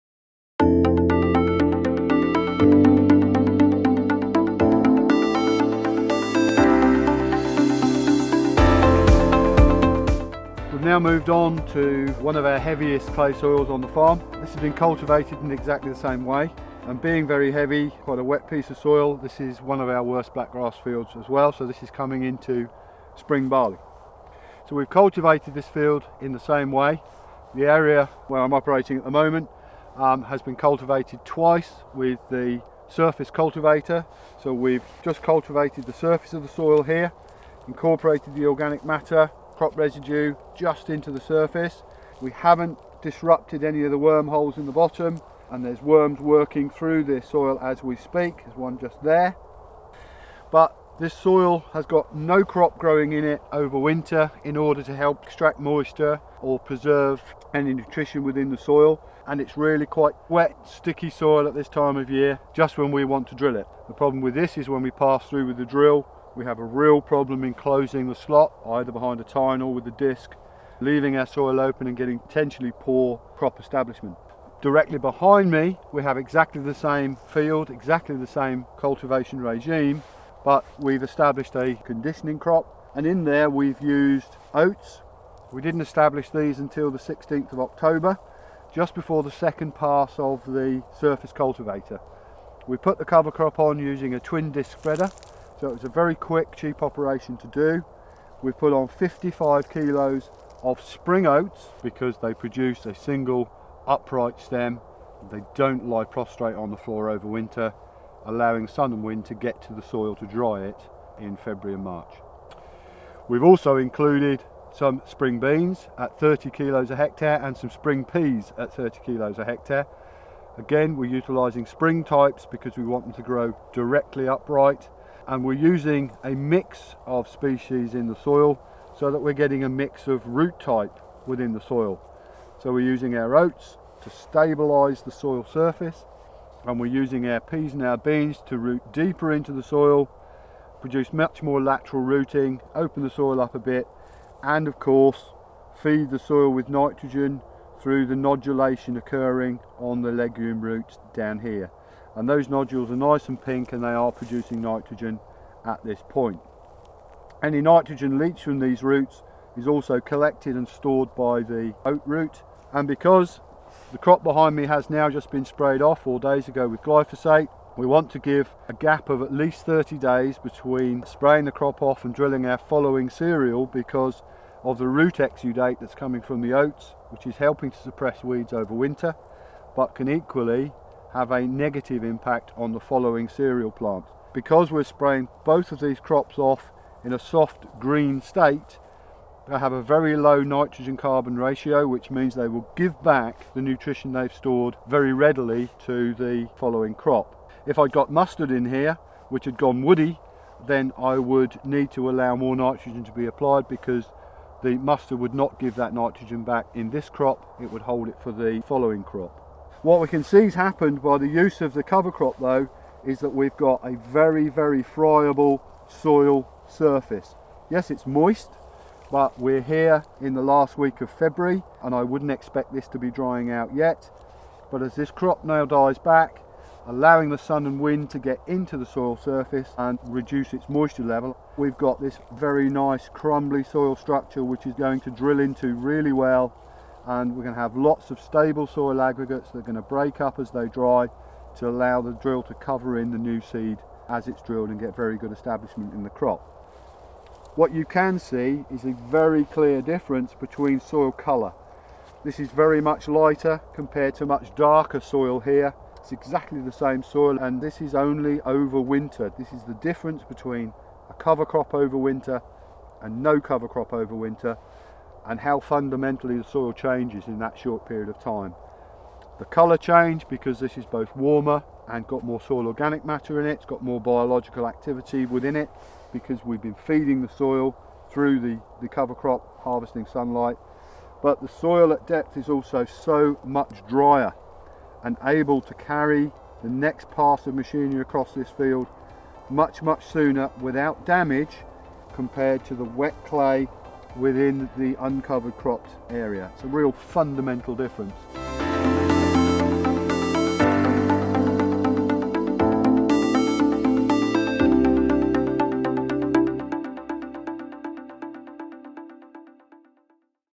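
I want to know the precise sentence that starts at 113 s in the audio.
We've also included some spring beans at 30 kilos a hectare and some spring peas at 30 kilos a hectare.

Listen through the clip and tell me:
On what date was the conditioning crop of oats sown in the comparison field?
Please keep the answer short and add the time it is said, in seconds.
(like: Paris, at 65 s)
16th of October, at 86 s.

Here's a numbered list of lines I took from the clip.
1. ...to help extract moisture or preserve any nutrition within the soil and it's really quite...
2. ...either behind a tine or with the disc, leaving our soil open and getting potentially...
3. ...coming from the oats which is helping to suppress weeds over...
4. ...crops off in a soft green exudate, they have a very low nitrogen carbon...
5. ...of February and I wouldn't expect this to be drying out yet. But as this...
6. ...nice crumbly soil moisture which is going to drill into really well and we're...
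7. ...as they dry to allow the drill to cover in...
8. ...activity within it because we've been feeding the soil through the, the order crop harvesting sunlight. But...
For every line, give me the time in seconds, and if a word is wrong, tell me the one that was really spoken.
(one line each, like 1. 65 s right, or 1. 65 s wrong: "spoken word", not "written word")
1. 54 s right
2. 68 s right
3. 175 s right
4. 185 s wrong: "state", not "exudate"
5. 221 s right
6. 232 s wrong: "structure", not "moisture"
7. 240 s right
8. 274 s wrong: "cover", not "order".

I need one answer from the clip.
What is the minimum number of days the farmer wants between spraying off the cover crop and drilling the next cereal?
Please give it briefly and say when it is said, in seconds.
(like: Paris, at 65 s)
30 days, at 169 s.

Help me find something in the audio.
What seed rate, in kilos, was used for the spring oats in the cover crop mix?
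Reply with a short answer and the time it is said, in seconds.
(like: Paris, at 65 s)
55 kilos, at 98 s.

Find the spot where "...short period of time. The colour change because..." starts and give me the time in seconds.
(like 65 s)
267 s.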